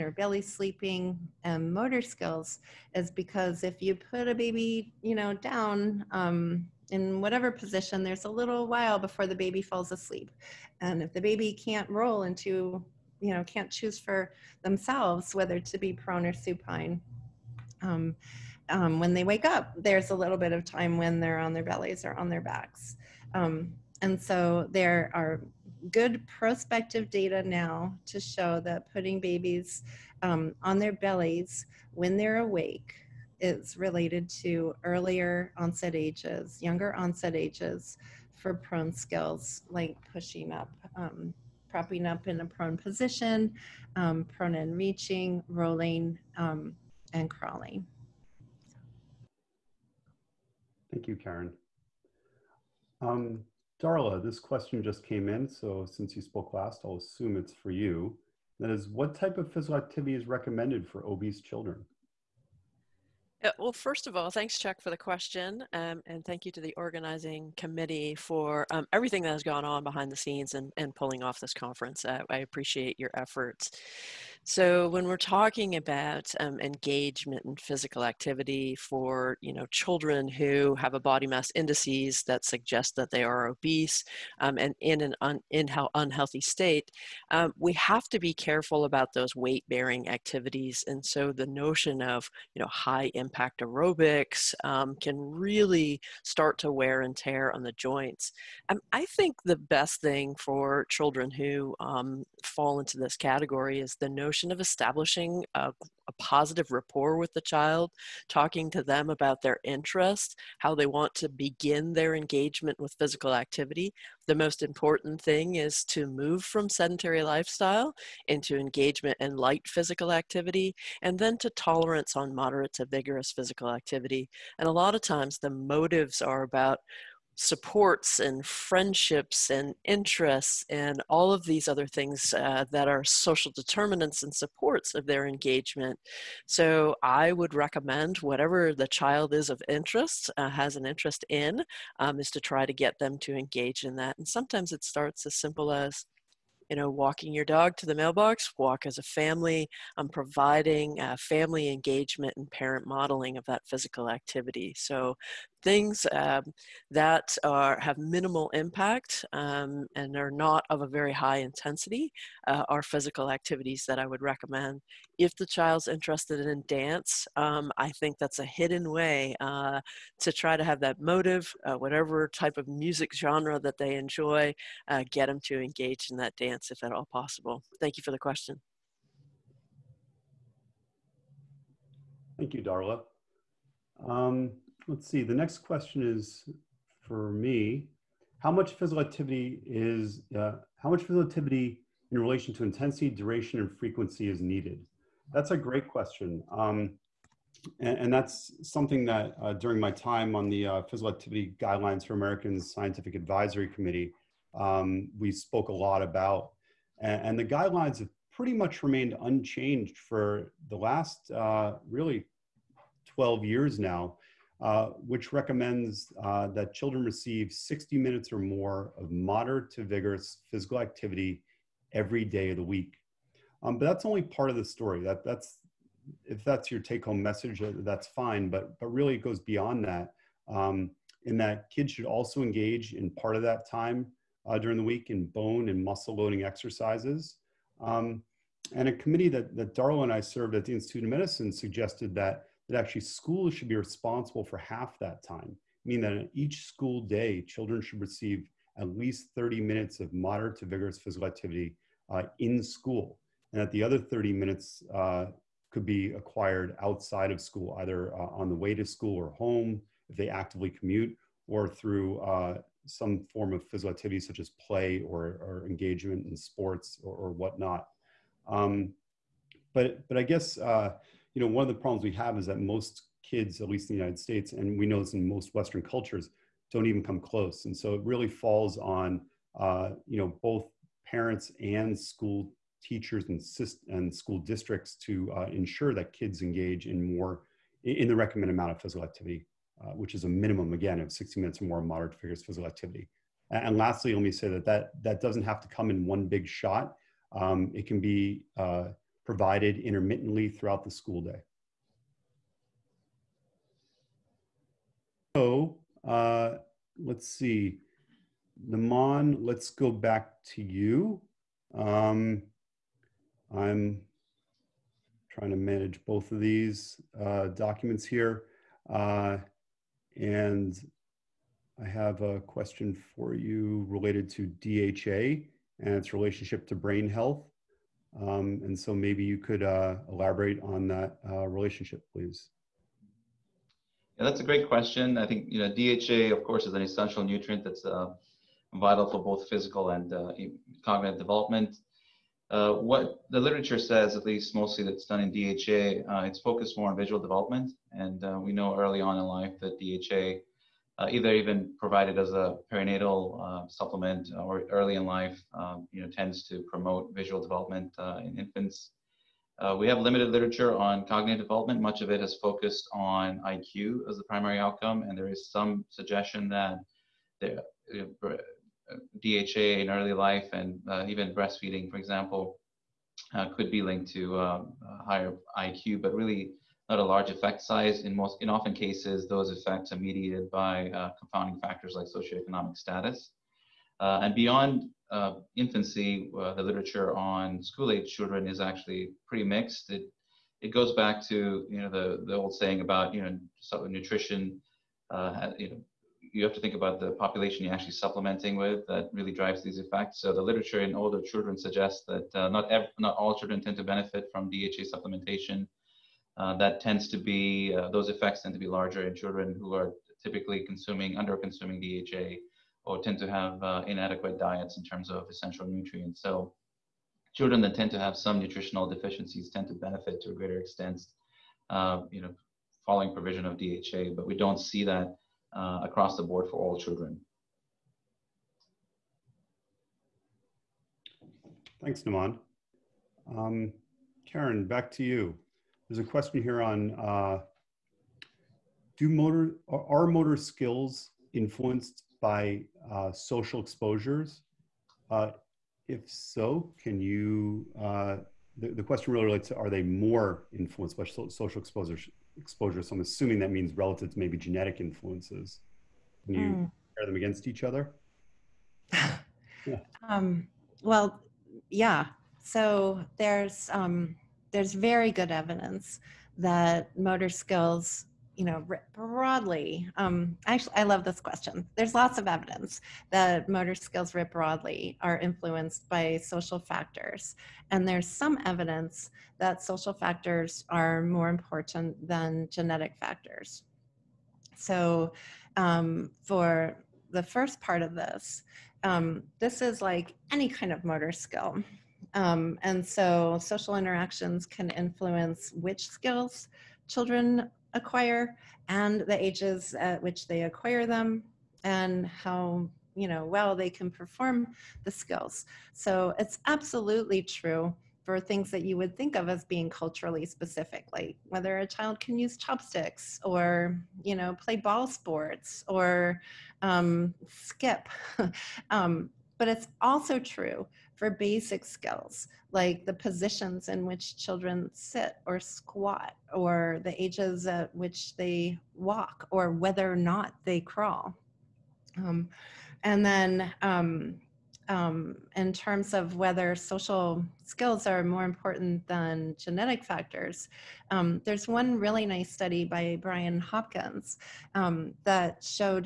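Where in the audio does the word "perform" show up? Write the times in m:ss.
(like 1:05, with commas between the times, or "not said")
8:23.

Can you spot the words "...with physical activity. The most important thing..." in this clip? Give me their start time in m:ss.
1:52.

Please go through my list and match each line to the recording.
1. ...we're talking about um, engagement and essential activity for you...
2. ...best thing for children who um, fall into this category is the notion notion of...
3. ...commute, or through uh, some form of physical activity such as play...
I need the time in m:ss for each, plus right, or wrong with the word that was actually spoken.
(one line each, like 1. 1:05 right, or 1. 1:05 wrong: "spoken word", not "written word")
1. 1:15 wrong: "physical", not "essential"
2. 1:39 right
3. 4:20 right.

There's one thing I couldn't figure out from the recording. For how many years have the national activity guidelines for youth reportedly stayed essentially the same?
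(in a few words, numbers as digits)
12.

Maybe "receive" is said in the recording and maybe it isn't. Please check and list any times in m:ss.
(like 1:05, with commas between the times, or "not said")
3:37, 4:07.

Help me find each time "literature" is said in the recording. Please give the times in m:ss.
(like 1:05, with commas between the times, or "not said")
5:43, 6:00, 6:26, 6:40.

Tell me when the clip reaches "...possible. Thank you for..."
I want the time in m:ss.
2:57.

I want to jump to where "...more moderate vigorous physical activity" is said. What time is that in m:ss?
4:51.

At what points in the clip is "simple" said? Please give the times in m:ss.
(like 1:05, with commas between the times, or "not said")
2:25.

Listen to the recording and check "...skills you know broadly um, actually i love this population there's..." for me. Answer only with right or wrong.
wrong.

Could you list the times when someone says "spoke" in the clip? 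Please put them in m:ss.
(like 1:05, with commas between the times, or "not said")
0:56, 3:25.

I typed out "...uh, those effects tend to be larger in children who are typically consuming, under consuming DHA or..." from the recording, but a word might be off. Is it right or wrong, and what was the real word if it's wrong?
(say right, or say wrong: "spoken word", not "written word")
right.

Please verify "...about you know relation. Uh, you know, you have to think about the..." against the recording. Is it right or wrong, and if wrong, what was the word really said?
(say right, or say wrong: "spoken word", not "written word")
wrong: "nutrition", not "relation".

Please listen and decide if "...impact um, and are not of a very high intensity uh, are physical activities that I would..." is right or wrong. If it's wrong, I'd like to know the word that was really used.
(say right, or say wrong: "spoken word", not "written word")
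right.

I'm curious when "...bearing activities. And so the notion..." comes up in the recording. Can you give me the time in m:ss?
1:29.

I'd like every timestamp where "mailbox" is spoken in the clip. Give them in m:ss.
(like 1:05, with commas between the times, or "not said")
2:27.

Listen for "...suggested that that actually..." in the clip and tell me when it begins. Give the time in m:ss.
4:01.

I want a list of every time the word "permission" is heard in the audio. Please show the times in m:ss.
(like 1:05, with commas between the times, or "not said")
not said.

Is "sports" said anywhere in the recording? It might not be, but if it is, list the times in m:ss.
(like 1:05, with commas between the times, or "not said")
4:26, 8:34.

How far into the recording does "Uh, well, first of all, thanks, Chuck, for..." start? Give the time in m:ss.
1:03.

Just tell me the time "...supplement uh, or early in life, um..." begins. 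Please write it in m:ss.
5:53.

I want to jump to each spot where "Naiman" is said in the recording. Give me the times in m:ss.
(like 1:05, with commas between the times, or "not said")
5:08, 7:12.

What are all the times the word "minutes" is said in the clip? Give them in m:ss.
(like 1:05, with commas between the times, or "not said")
3:37, 4:09, 4:14, 4:51.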